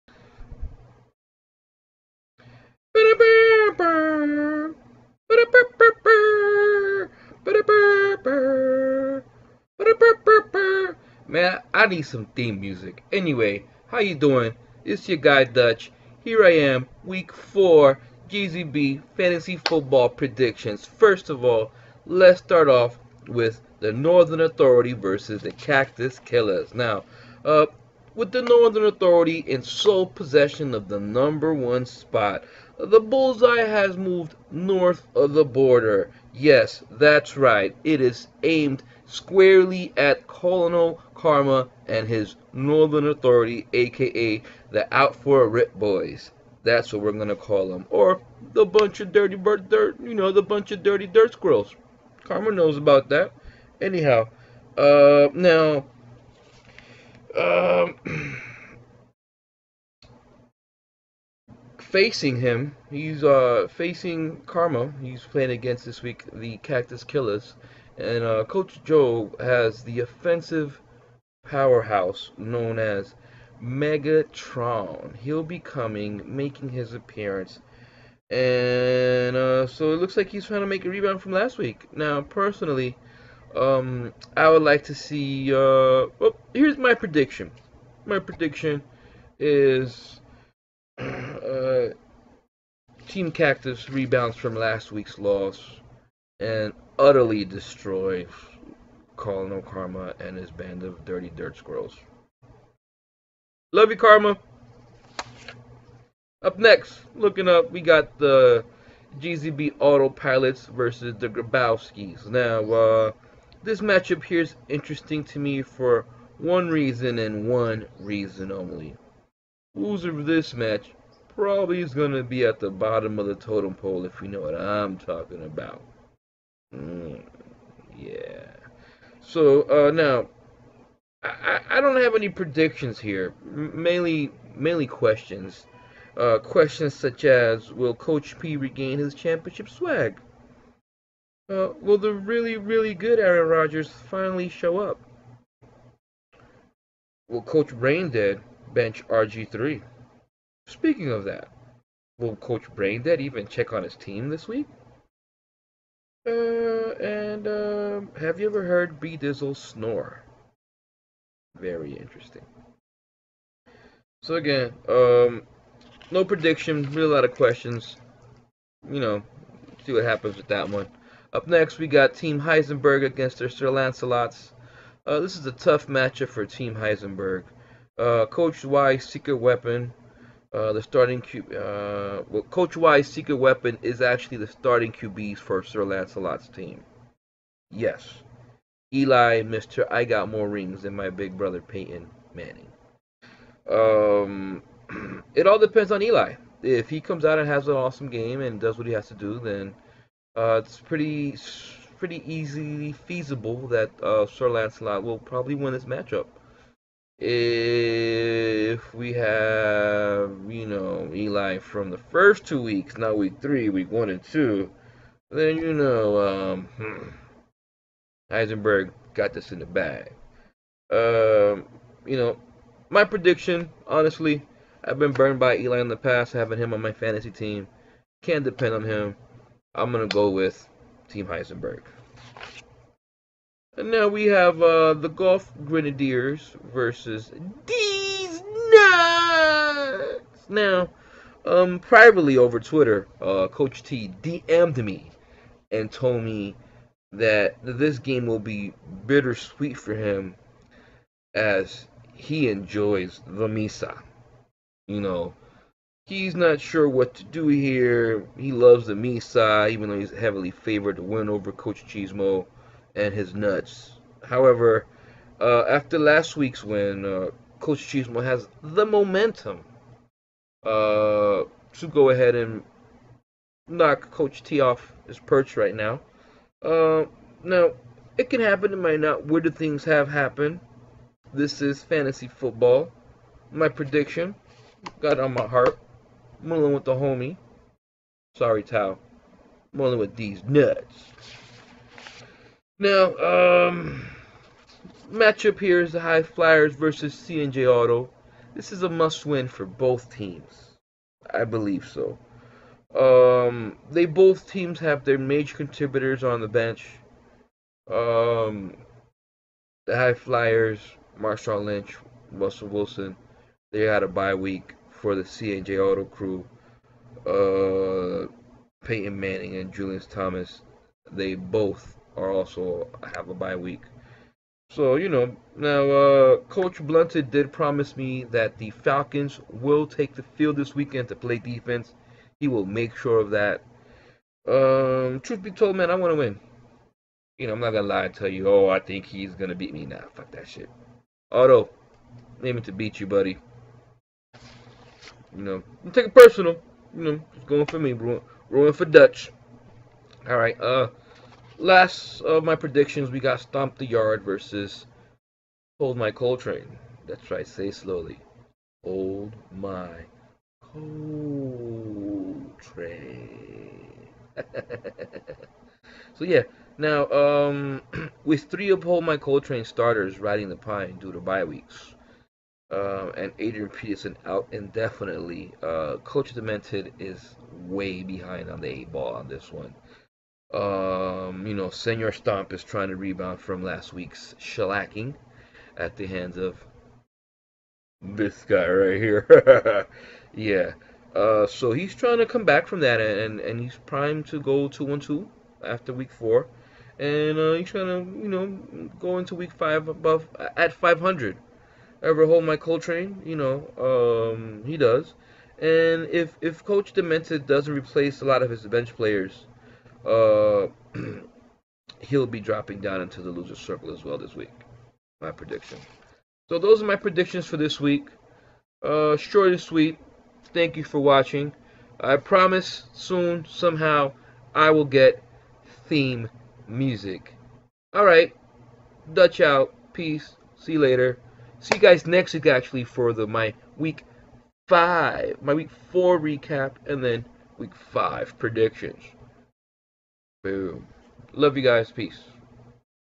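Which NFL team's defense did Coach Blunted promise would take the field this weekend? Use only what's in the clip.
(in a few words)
Falcons.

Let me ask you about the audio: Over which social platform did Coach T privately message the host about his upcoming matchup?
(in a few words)
Twitter.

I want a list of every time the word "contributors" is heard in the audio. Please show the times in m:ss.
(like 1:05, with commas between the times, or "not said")
5:05.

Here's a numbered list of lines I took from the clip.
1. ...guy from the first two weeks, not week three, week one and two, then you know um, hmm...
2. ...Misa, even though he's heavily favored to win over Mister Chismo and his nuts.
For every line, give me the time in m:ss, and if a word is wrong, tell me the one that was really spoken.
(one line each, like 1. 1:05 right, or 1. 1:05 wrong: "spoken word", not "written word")
1. 3:31 right
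2. 4:18 wrong: "Coach", not "Mister".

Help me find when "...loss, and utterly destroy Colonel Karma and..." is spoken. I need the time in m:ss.
1:35.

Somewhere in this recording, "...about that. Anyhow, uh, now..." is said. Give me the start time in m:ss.
0:52.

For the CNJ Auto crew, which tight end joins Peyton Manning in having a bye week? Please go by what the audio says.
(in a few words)
Julius Thomas.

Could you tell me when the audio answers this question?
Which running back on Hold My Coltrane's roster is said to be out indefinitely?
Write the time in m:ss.
6:13.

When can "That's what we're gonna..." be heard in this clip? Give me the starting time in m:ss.
0:46.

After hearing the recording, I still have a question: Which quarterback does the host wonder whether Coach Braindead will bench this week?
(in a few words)
RG3.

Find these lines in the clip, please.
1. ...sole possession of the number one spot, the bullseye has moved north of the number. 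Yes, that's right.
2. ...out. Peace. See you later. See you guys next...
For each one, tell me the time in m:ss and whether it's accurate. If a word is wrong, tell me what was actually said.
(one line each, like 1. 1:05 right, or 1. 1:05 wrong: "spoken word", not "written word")
1. 0:29 wrong: "border", not "number"
2. 7:09 right.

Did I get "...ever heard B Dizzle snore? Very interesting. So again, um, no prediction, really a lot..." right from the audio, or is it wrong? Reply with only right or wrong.
right.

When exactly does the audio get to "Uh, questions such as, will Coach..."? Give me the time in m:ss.
2:16.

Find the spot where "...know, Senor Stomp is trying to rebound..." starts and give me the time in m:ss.
6:21.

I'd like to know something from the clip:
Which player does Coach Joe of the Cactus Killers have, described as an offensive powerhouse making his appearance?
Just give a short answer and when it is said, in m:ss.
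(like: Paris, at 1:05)
Megatron, at 1:13.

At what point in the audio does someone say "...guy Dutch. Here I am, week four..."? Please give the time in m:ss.
0:15.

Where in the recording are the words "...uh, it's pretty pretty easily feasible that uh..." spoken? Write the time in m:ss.
3:20.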